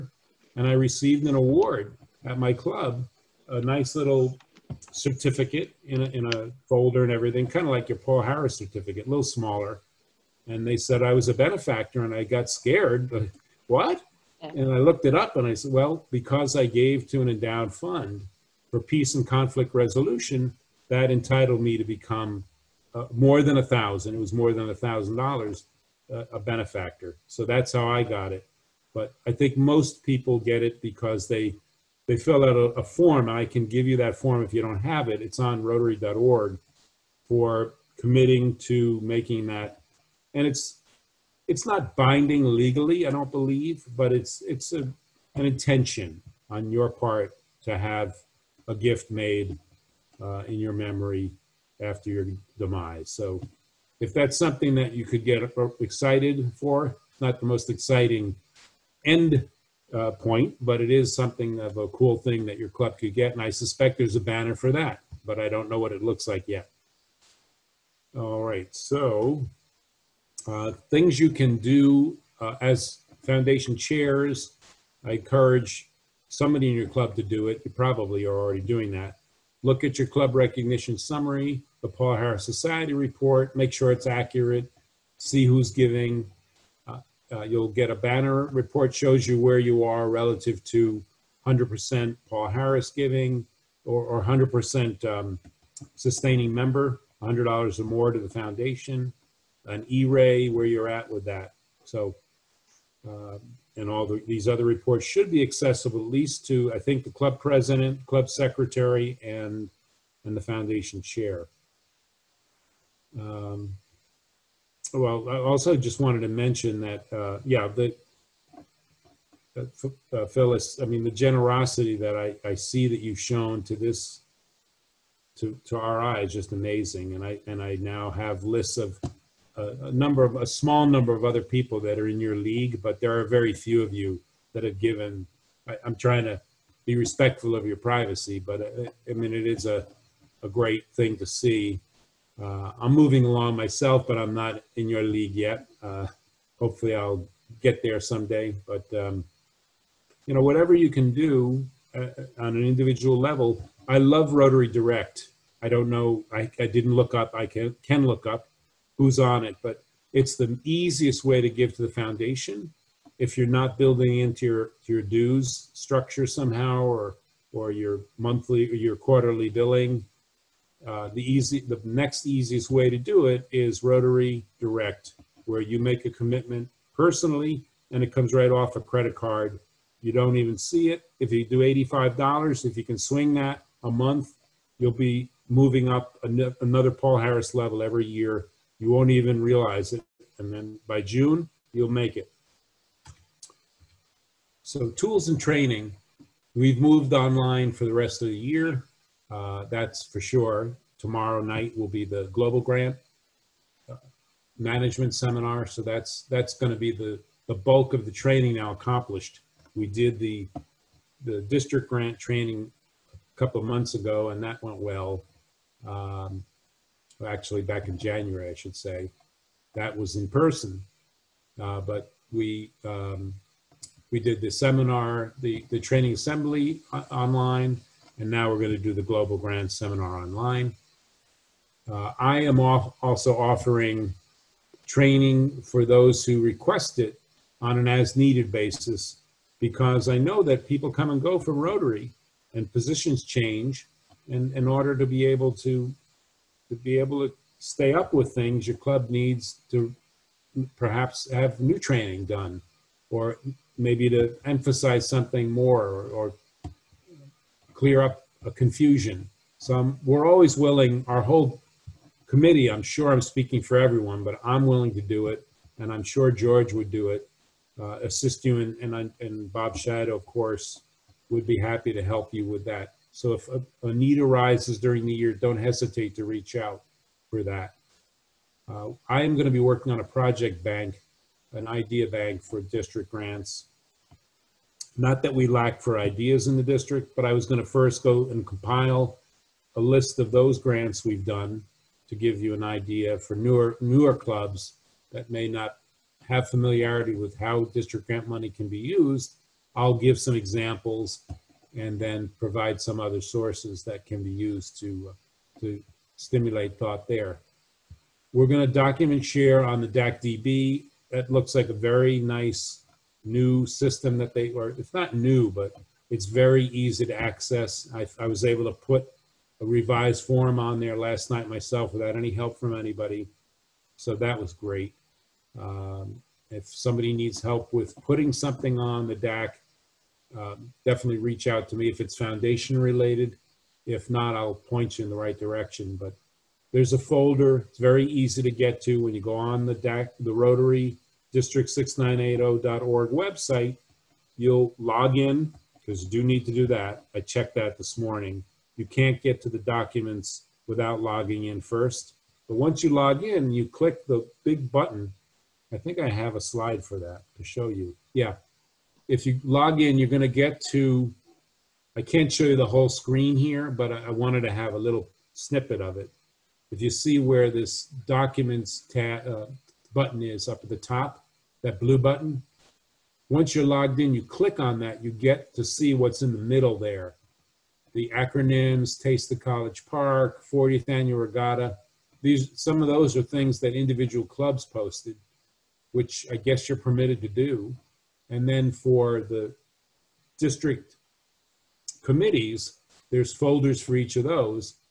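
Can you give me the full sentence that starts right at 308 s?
We're gonna document share on the DACDB.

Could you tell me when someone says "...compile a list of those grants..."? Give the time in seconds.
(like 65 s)
288 s.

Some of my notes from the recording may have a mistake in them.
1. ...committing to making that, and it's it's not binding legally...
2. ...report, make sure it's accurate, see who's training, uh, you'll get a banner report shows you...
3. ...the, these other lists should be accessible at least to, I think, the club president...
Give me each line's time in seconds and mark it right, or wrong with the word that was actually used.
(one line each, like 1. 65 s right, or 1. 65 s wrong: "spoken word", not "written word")
1. 37 s right
2. 82 s wrong: "giving", not "training"
3. 104 s wrong: "reports", not "lists".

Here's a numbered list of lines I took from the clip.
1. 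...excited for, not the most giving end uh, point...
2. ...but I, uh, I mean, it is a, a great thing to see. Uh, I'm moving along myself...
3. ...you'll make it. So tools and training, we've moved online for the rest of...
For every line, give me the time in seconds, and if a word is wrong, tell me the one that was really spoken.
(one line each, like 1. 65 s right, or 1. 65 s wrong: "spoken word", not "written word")
1. 55 s wrong: "exciting", not "giving"
2. 138 s right
3. 191 s right.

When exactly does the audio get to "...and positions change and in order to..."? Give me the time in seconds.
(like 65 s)
242 s.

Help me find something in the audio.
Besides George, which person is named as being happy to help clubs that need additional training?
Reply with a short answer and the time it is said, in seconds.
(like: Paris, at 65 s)
Bob Shadow, at 269 s.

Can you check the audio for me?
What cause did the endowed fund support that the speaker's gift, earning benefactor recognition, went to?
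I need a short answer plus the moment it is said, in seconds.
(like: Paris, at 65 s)
peace and conflict resolution, at 18 s.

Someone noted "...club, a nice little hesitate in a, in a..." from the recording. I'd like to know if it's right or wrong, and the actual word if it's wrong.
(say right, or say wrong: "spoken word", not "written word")
wrong: "certificate", not "hesitate".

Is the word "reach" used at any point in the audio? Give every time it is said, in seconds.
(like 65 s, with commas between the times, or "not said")
276 s, 331 s.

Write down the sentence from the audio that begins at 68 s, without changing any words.
All right, so uh, things you can do uh, as foundation chairs, I encourage somebody in your club to do it.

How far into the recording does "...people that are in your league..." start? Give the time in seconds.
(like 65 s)
131 s.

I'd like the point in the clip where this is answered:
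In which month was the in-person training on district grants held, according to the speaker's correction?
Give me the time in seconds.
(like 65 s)
217 s.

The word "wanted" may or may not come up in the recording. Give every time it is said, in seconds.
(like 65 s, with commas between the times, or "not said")
116 s, 364 s.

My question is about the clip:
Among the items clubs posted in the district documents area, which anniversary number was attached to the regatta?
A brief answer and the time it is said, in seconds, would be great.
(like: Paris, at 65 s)
40th, at 380 s.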